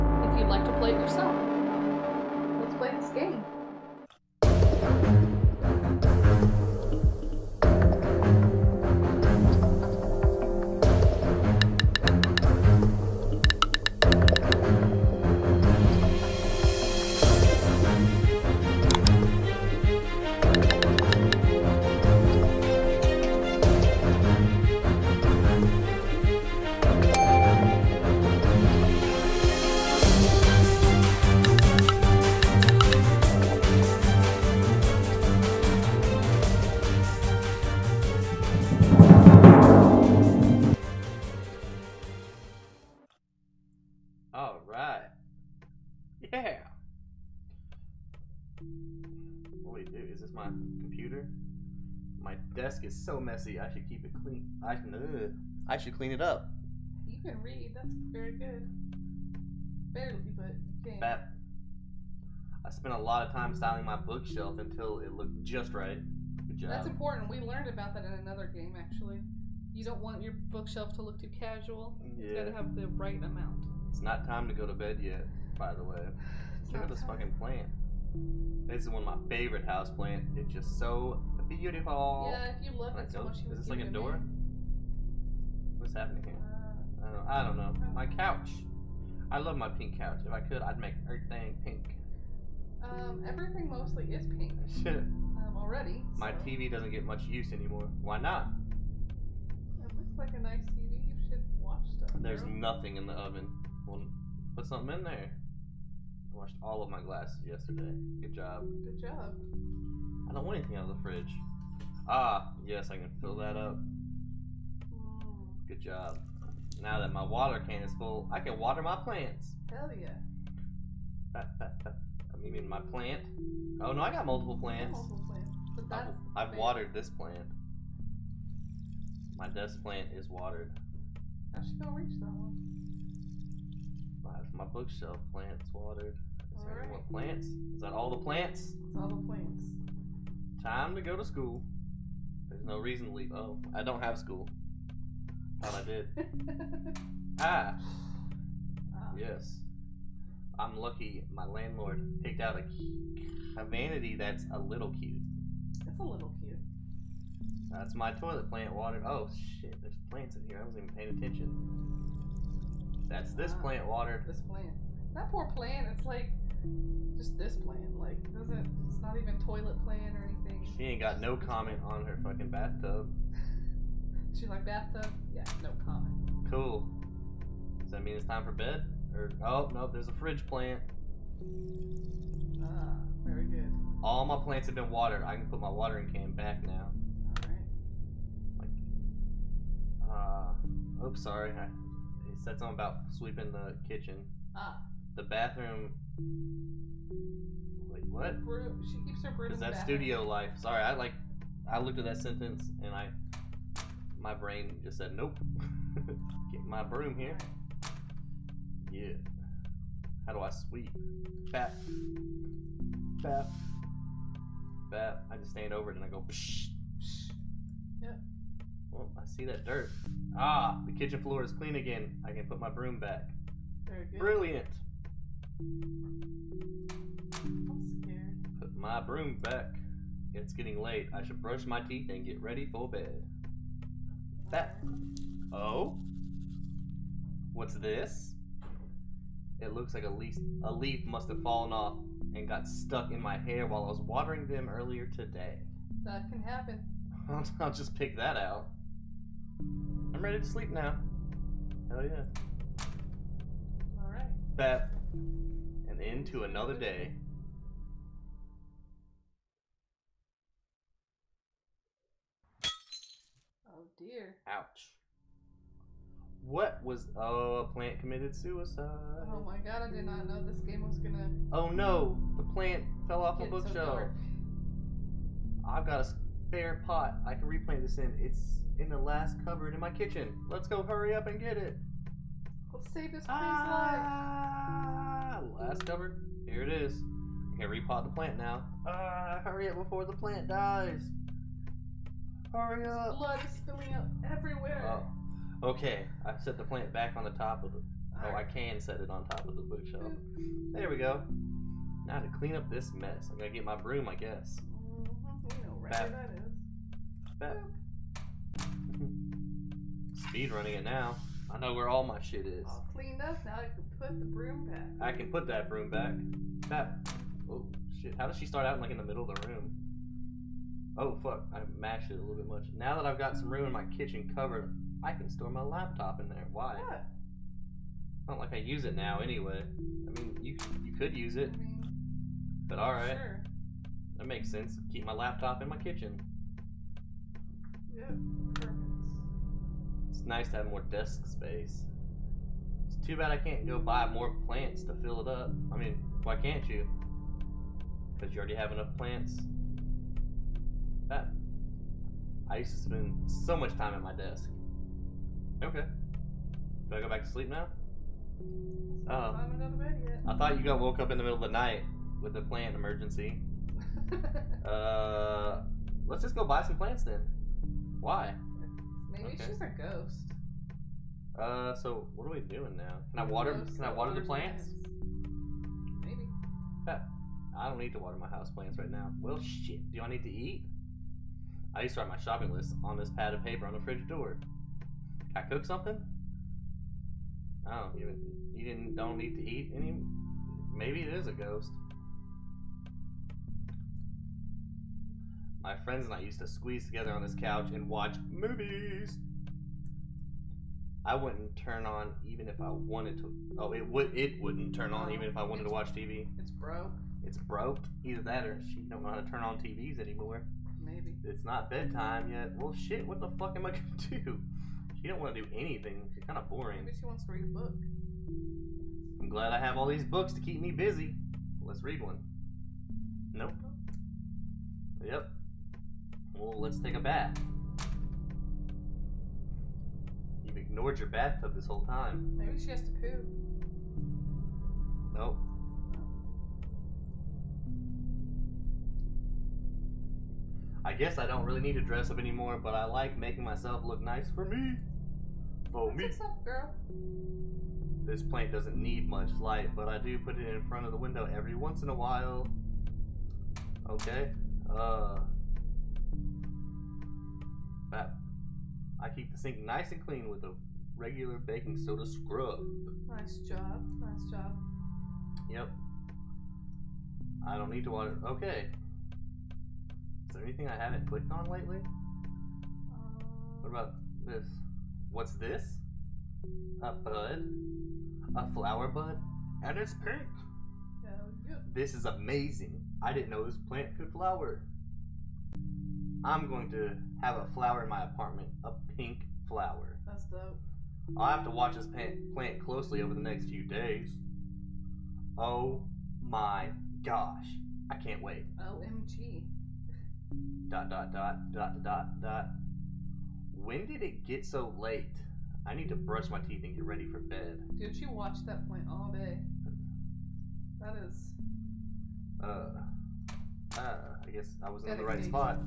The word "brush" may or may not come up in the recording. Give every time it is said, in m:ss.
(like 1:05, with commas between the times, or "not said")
3:51, 8:25.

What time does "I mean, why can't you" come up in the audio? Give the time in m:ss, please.
5:45.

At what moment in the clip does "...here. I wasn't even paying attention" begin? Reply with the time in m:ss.
2:40.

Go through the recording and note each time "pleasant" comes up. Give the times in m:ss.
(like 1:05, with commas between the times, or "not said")
not said.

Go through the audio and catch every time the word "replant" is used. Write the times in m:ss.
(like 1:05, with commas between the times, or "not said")
4:37.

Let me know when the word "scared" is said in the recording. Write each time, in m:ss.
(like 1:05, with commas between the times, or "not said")
3:48.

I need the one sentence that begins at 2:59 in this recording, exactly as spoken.
Or oh no, there's a fridge plant.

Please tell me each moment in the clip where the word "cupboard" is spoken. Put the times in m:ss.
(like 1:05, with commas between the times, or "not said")
4:39.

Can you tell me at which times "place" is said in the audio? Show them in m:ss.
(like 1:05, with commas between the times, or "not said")
not said.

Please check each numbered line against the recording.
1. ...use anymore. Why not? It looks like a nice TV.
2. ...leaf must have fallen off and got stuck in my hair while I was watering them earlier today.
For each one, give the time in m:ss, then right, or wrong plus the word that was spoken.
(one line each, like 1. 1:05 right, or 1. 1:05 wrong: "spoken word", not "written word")
1. 1:37 right
2. 4:00 right.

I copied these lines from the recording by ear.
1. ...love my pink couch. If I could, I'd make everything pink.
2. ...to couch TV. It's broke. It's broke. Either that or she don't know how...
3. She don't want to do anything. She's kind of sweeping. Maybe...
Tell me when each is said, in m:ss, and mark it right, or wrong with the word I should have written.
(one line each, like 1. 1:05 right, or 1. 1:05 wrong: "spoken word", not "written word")
1. 1:29 right
2. 6:45 wrong: "watch", not "couch"
3. 6:55 wrong: "boring", not "sweeping".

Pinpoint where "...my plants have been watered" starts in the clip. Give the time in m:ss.
3:04.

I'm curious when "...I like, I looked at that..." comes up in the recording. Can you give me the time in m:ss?
3:20.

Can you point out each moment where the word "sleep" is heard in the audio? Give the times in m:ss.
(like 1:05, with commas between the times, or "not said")
4:10, 5:57.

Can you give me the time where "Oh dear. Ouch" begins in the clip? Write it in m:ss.
4:23.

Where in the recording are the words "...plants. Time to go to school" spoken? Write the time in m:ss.
2:19.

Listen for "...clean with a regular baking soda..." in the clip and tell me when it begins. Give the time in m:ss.
7:40.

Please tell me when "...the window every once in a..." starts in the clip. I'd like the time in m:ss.
7:30.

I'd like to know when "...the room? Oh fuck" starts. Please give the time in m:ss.
5:19.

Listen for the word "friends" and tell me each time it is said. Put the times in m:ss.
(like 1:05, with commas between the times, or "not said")
6:35.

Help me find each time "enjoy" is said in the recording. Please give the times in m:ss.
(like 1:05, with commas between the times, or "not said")
not said.